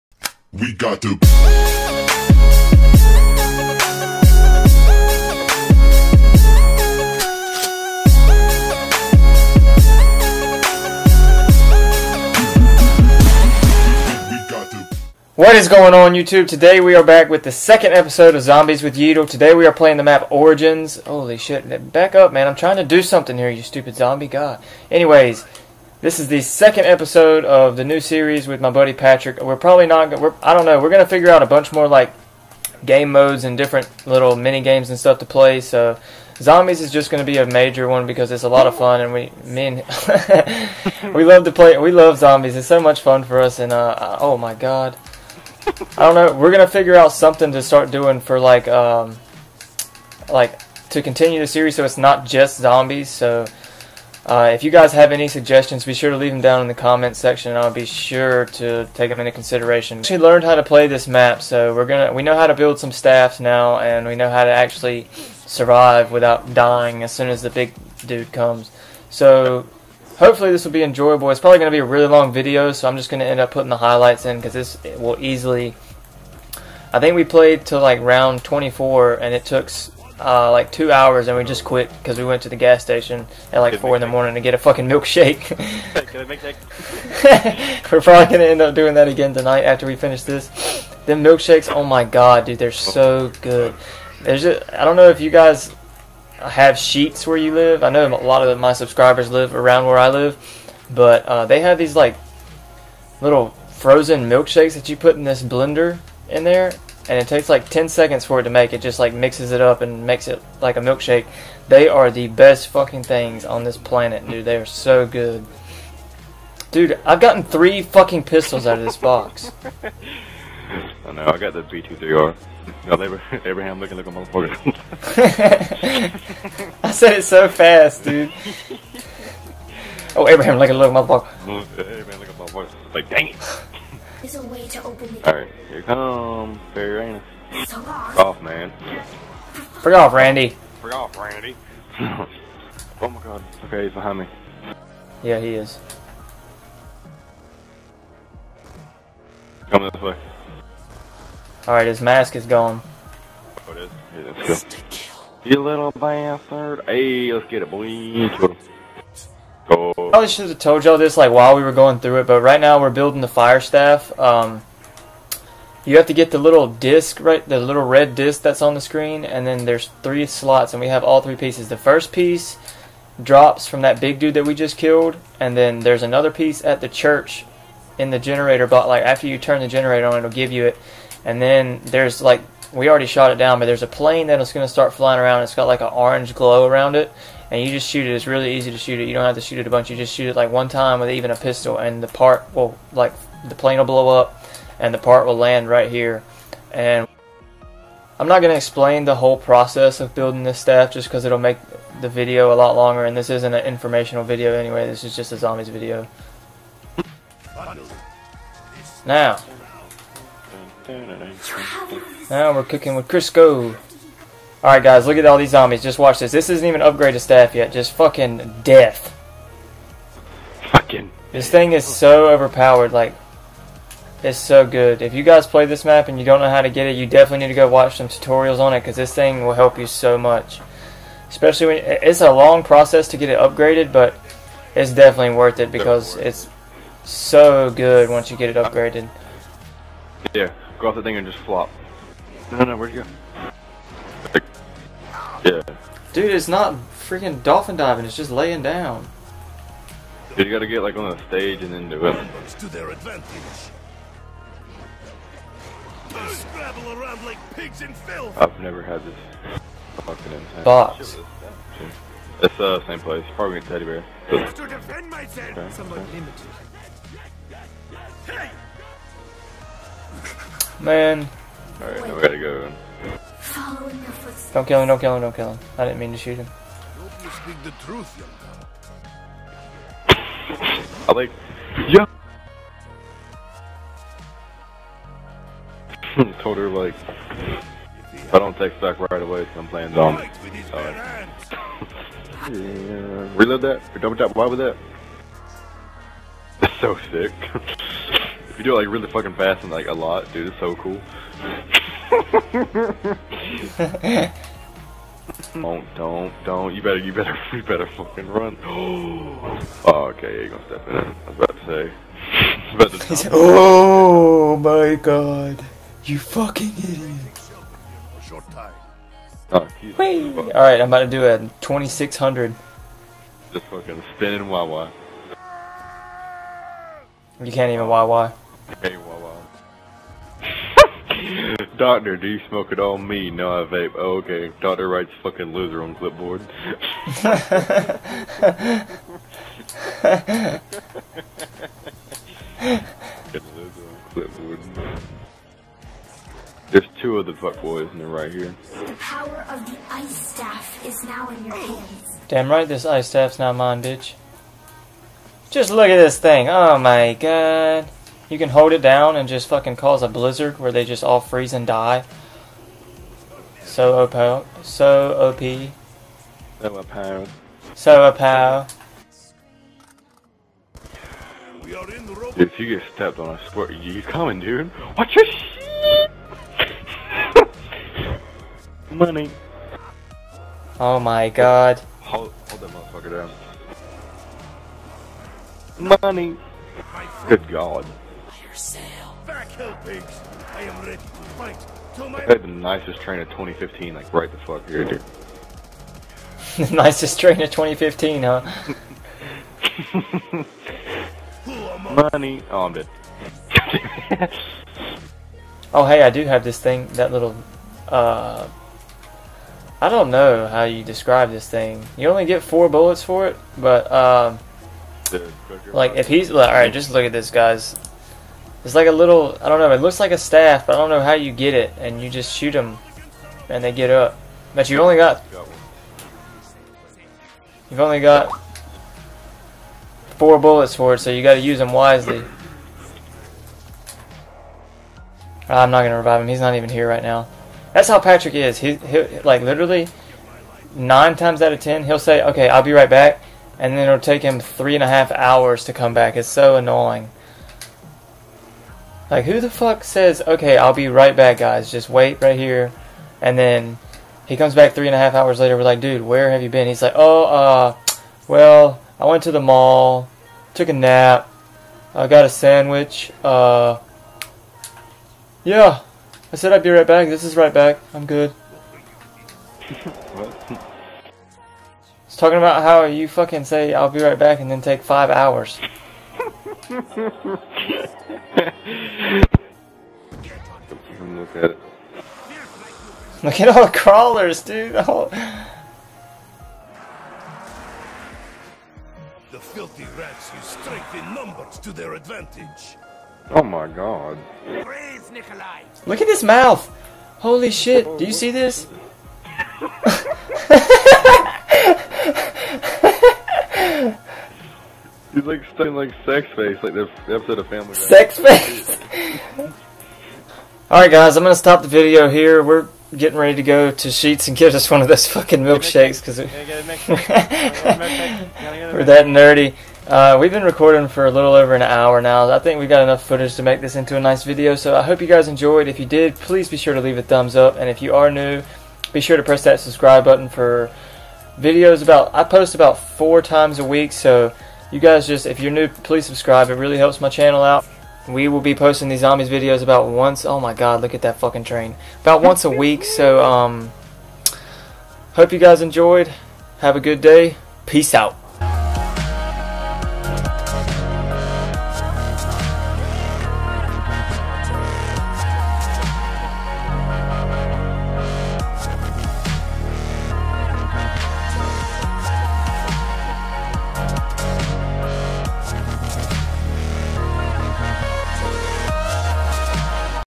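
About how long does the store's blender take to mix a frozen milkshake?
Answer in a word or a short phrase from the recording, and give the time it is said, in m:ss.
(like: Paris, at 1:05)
10 seconds, at 1:47.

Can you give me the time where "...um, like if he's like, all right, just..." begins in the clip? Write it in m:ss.
6:53.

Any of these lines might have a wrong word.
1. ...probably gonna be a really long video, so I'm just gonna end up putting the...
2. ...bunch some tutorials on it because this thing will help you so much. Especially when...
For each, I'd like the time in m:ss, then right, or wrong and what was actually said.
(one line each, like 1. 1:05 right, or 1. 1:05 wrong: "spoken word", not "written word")
1. 1:11 right
2. 3:47 wrong: "watch", not "bunch".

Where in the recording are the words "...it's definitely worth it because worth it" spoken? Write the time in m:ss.
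3:54.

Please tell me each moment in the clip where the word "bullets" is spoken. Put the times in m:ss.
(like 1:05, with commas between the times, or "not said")
6:52, 7:10.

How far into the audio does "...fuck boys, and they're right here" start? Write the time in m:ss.
5:47.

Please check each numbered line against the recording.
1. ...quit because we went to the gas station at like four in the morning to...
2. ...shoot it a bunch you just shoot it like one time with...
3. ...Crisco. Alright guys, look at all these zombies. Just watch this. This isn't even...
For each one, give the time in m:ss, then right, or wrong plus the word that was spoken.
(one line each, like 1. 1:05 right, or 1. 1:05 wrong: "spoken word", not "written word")
1. 1:21 right
2. 3:09 right
3. 3:33 right.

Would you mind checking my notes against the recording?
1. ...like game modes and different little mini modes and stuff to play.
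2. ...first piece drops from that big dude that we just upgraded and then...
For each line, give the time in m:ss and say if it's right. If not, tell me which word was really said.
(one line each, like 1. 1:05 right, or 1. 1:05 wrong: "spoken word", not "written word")
1. 0:31 wrong: "games", not "modes"
2. 2:51 wrong: "killed", not "upgraded".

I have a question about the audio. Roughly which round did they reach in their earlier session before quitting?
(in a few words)
24.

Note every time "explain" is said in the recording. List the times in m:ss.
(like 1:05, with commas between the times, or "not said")
3:18.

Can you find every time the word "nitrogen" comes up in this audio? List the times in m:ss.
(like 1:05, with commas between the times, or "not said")
not said.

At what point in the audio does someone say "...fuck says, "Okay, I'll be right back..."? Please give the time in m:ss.
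7:29.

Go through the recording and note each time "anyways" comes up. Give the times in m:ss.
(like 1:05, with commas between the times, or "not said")
0:24, 3:24.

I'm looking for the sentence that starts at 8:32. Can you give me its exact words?
We're getting ready to go to Sheetz and get us one of those fucking milkshakes because we, are that nerdy.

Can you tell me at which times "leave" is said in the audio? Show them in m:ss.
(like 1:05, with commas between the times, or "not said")
0:56, 8:46.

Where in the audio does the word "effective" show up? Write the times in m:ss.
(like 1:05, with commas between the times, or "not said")
not said.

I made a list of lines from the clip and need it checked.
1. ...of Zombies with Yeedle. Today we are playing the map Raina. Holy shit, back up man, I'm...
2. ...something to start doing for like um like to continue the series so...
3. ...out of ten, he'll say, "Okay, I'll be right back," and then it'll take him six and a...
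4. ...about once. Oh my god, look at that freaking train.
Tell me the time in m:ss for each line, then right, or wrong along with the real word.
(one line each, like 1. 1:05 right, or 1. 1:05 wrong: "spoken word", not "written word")
1. 0:18 wrong: "Origins", not "Raina"
2. 0:47 right
3. 7:21 wrong: "three", not "six"
4. 8:59 wrong: "fucking", not "freaking".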